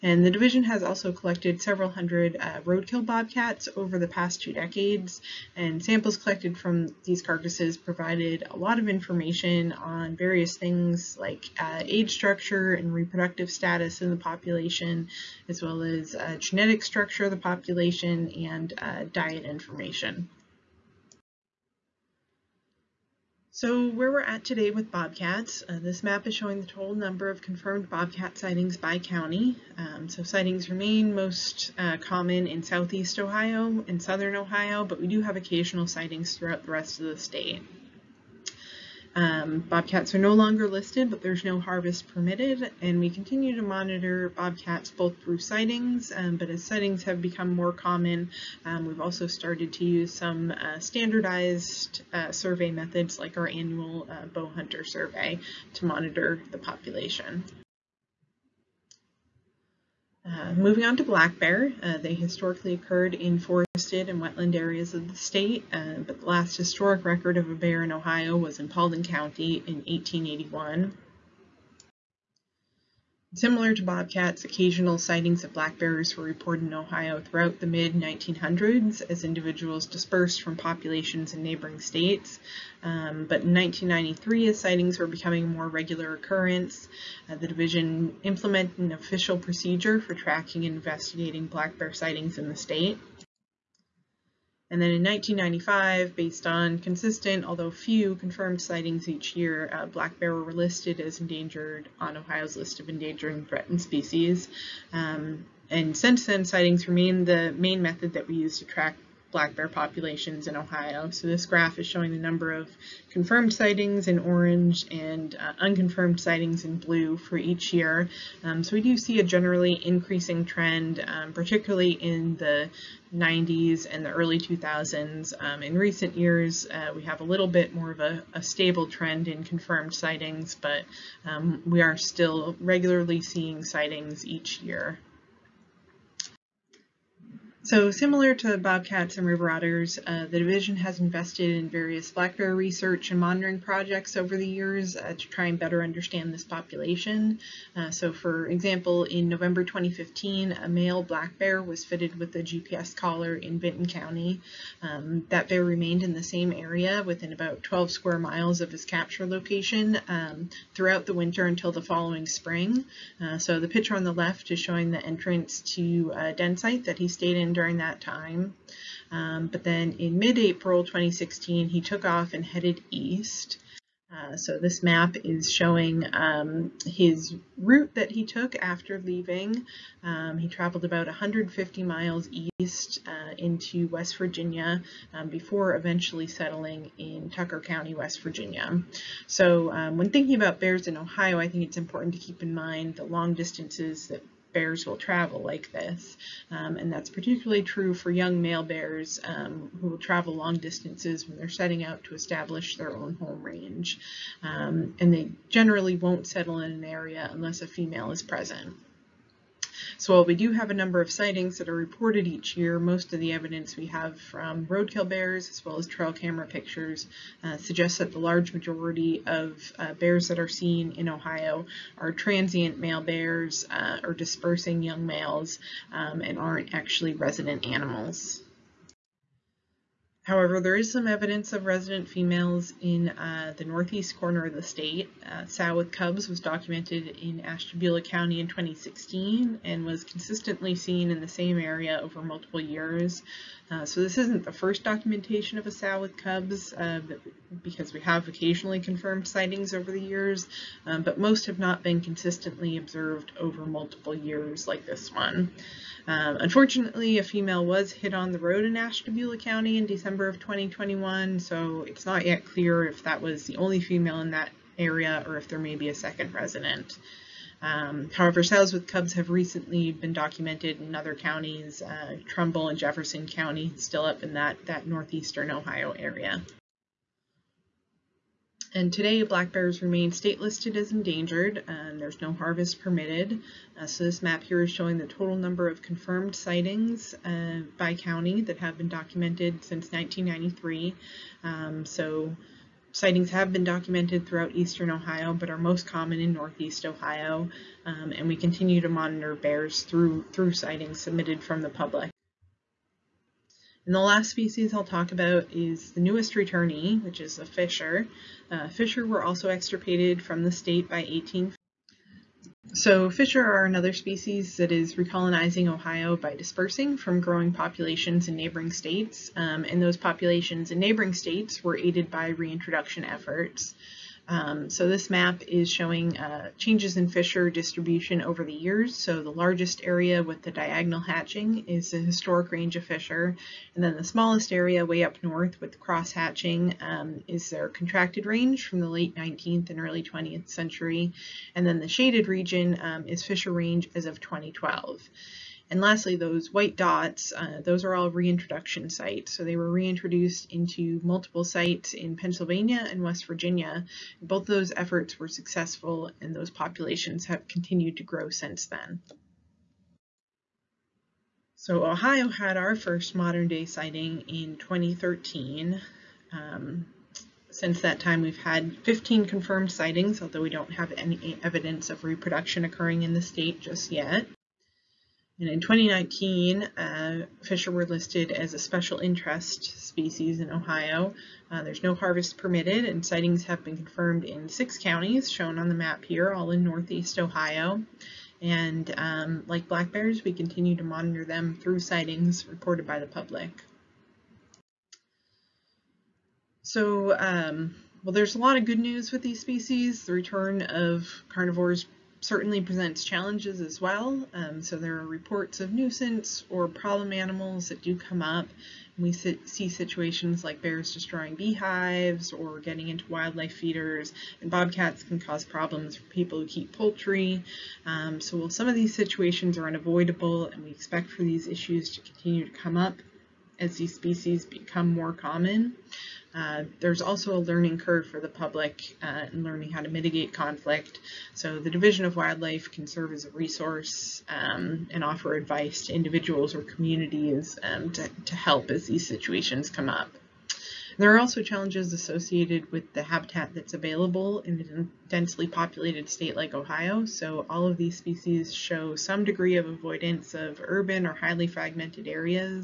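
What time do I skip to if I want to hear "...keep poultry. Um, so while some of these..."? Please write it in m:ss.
6:56.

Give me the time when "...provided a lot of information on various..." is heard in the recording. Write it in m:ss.
0:07.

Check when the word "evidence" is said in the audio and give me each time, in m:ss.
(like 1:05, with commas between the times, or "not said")
3:33, 3:51, 6:11.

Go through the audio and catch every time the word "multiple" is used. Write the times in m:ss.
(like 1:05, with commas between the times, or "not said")
4:02, 4:13, 5:51.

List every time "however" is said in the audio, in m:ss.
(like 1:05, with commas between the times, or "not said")
3:50, 4:28.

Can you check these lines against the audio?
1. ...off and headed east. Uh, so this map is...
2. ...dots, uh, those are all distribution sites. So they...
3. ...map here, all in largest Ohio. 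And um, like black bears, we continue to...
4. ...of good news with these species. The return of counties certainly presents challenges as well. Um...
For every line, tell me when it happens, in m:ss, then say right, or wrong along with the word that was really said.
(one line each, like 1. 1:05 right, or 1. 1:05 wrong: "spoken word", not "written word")
1. 2:52 right
2. 5:46 wrong: "reintroduction", not "distribution"
3. 6:25 wrong: "northeast", not "largest"
4. 6:38 wrong: "carnivores", not "counties".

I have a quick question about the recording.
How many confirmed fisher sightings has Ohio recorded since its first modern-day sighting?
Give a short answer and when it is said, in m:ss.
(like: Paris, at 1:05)
15, at 6:08.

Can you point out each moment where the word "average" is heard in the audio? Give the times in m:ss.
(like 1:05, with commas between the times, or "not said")
not said.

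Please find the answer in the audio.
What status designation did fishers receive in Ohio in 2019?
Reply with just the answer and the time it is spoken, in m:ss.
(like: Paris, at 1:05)
special interest species, at 6:18.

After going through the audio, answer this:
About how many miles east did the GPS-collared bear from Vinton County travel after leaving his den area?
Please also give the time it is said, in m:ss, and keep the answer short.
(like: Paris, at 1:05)
150, at 3:01.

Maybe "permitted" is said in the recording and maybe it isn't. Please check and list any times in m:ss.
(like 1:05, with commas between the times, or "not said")
0:42, 4:42, 6:22.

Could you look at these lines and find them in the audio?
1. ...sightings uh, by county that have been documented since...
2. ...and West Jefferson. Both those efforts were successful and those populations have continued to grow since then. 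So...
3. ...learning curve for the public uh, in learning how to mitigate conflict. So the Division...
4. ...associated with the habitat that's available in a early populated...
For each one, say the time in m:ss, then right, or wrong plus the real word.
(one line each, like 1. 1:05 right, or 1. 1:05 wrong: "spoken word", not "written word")
1. 4:46 right
2. 5:52 wrong: "Virginia", not "Jefferson"
3. 7:07 right
4. 7:21 wrong: "densely", not "early".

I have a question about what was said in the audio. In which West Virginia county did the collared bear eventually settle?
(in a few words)
Tucker County.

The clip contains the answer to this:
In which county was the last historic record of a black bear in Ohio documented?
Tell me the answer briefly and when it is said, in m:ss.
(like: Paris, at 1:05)
Paulding County, at 1:08.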